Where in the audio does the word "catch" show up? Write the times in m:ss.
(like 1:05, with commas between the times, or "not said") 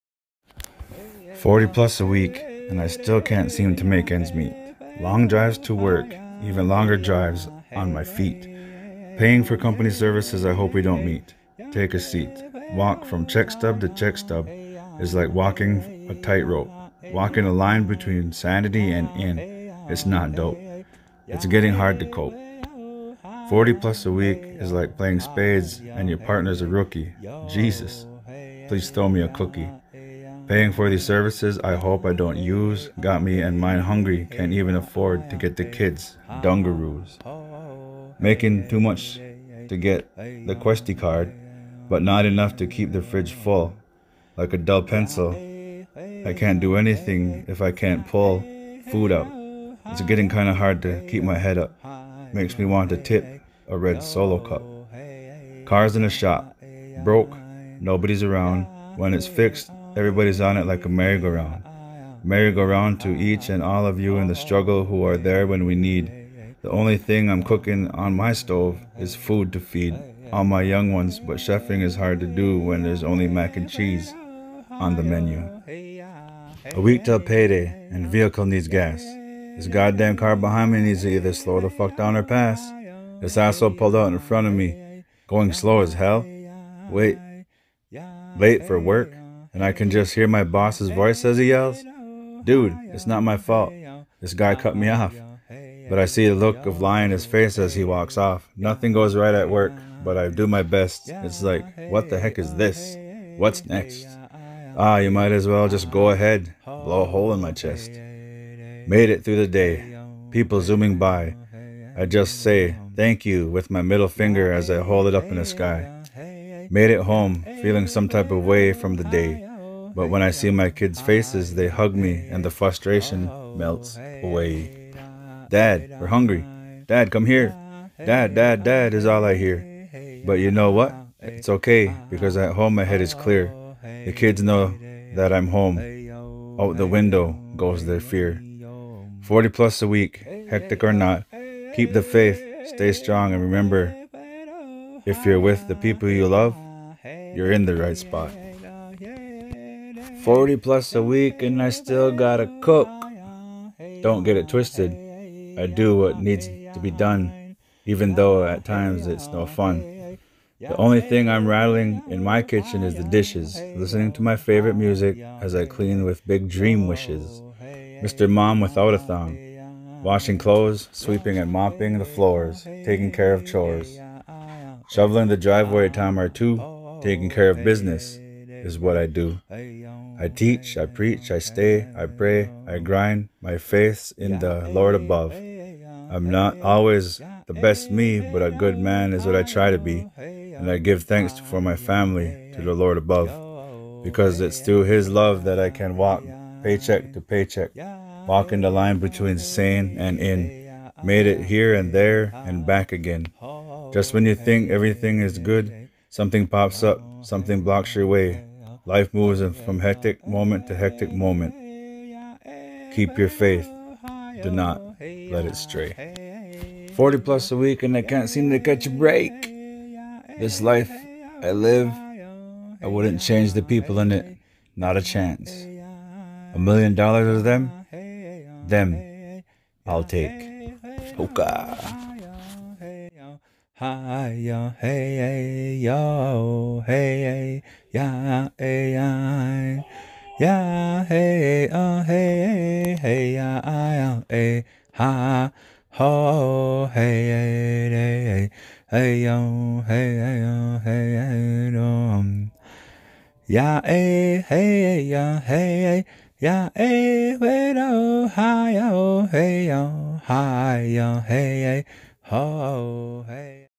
3:38.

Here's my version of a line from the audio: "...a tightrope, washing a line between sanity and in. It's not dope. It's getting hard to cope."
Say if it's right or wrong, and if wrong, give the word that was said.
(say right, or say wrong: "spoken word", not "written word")
wrong: "walking", not "washing".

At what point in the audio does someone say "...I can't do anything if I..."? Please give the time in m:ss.
0:46.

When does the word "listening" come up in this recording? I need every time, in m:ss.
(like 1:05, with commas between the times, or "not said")
2:43.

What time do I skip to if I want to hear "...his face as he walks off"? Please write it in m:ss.
1:37.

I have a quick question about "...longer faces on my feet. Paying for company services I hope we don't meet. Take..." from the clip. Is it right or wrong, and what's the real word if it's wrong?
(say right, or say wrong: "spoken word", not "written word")
wrong: "drives", not "faces".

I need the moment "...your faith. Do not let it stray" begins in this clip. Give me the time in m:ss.
3:33.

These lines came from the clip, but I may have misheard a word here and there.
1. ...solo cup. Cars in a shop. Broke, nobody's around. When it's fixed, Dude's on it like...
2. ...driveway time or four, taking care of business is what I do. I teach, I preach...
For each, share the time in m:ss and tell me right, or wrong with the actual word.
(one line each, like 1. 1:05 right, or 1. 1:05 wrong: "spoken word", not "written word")
1. 0:54 wrong: "Everybody", not "Dude"
2. 2:55 wrong: "two", not "four".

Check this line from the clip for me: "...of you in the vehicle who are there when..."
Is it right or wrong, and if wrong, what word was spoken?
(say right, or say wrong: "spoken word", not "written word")
wrong: "struggle", not "vehicle".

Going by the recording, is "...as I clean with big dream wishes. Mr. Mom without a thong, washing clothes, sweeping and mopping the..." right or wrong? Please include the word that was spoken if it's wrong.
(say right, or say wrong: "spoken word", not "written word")
right.